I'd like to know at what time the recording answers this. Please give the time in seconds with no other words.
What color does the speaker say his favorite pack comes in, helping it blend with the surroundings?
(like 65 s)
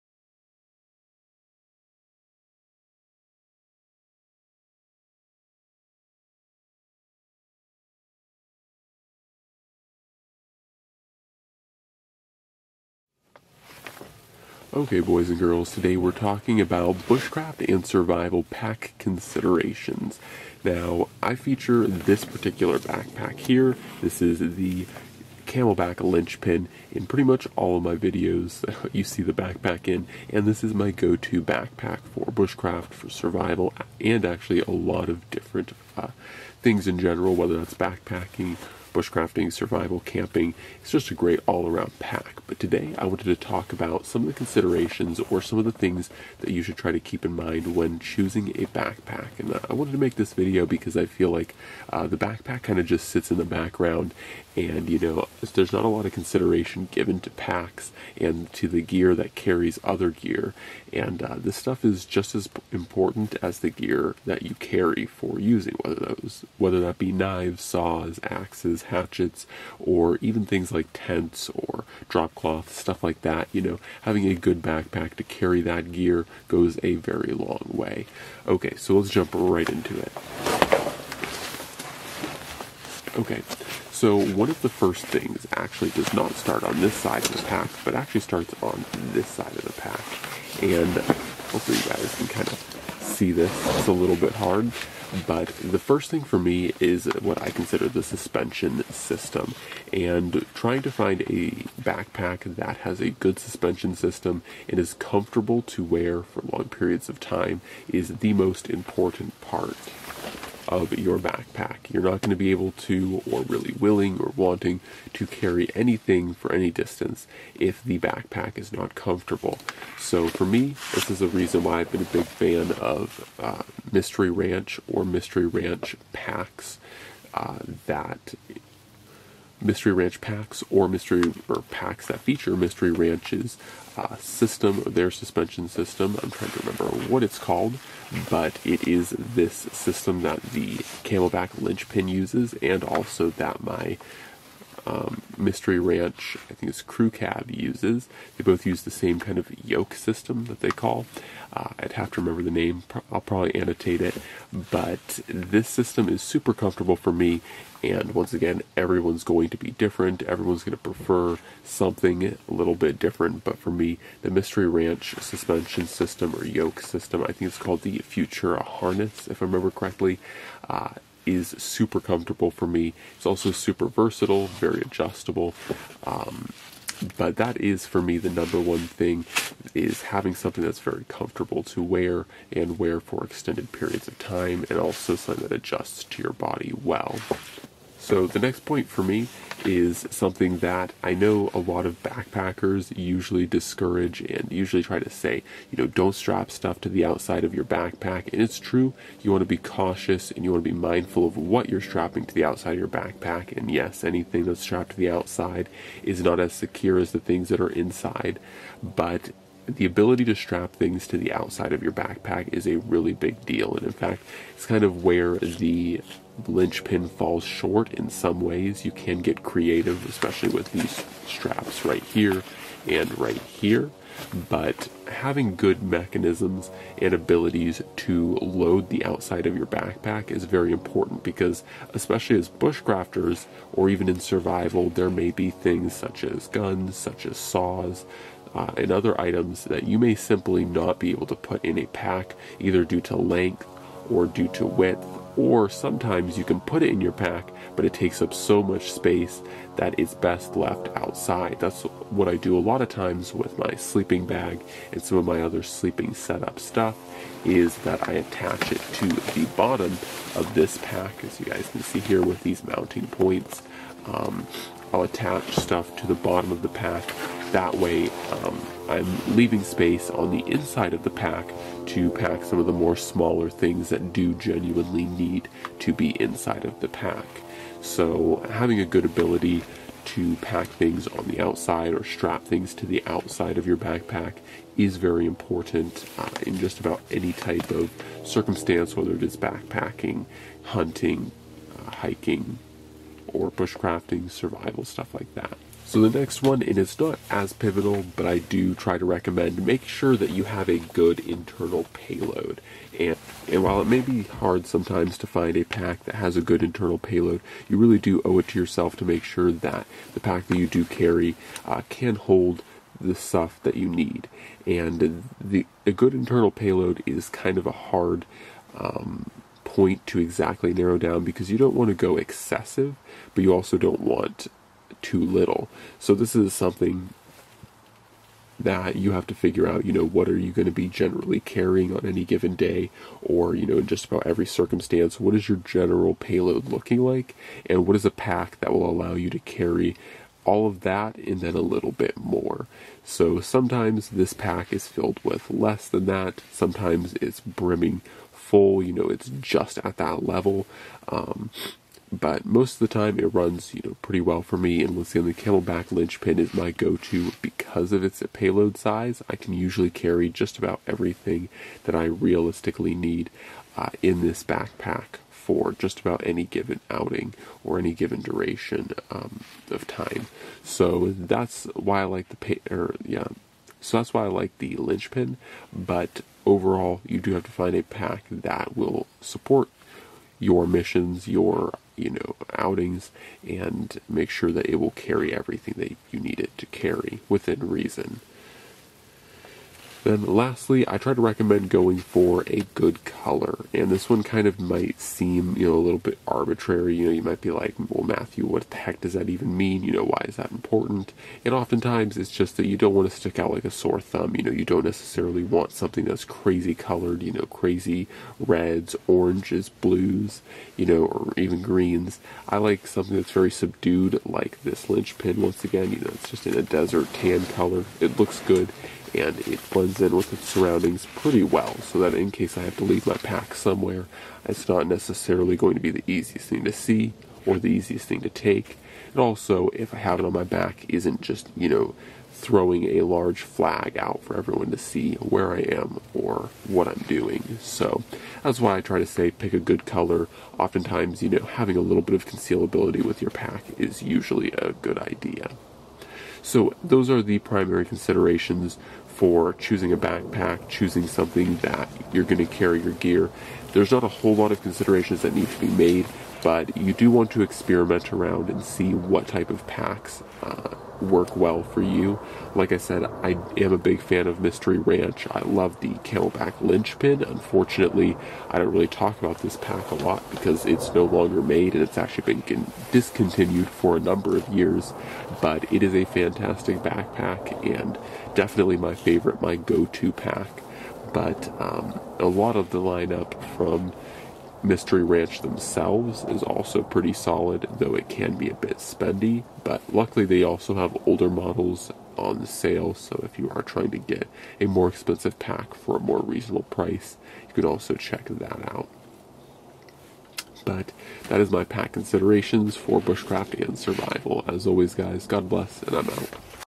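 416 s.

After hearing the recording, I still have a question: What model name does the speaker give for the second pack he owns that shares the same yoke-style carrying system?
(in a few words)
Crew Cab.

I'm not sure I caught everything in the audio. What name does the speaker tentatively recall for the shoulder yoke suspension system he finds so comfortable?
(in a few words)
Futura Harness.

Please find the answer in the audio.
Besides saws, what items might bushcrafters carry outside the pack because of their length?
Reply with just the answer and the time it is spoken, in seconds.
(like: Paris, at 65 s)
Guns, at 236 s.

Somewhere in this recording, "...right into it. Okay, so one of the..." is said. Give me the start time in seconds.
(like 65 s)
79 s.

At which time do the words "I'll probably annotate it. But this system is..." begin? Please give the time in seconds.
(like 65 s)
153 s.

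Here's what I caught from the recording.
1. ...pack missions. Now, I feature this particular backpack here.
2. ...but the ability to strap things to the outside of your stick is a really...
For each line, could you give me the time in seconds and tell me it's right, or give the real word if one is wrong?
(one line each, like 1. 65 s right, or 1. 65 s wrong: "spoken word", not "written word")
1. 18 s wrong: "considerations", not "missions"
2. 208 s wrong: "backpack", not "stick".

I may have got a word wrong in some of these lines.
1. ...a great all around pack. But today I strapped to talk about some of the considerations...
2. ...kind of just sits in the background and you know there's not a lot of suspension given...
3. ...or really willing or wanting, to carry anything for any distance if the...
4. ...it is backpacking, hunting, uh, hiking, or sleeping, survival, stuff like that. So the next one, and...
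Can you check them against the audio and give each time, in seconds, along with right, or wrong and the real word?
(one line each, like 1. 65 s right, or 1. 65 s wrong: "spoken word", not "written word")
1. 41 s wrong: "wanted", not "strapped"
2. 52 s wrong: "consideration", not "suspension"
3. 113 s right
4. 289 s wrong: "bushcrafting", not "sleeping".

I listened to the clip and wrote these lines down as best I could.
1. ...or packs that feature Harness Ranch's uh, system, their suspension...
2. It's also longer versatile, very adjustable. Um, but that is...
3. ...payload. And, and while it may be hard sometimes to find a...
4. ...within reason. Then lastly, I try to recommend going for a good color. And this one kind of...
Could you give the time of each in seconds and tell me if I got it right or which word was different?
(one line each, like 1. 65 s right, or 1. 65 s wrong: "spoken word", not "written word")
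1. 131 s wrong: "Mystery", not "Harness"
2. 173 s wrong: "super", not "longer"
3. 301 s right
4. 387 s right.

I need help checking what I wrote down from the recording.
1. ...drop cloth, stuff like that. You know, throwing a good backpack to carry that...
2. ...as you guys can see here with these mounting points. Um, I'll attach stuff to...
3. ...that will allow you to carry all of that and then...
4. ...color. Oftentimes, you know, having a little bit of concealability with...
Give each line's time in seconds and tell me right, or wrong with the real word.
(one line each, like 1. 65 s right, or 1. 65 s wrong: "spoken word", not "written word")
1. 72 s wrong: "having", not "throwing"
2. 261 s right
3. 338 s right
4. 439 s right.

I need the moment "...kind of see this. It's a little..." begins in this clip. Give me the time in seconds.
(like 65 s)
92 s.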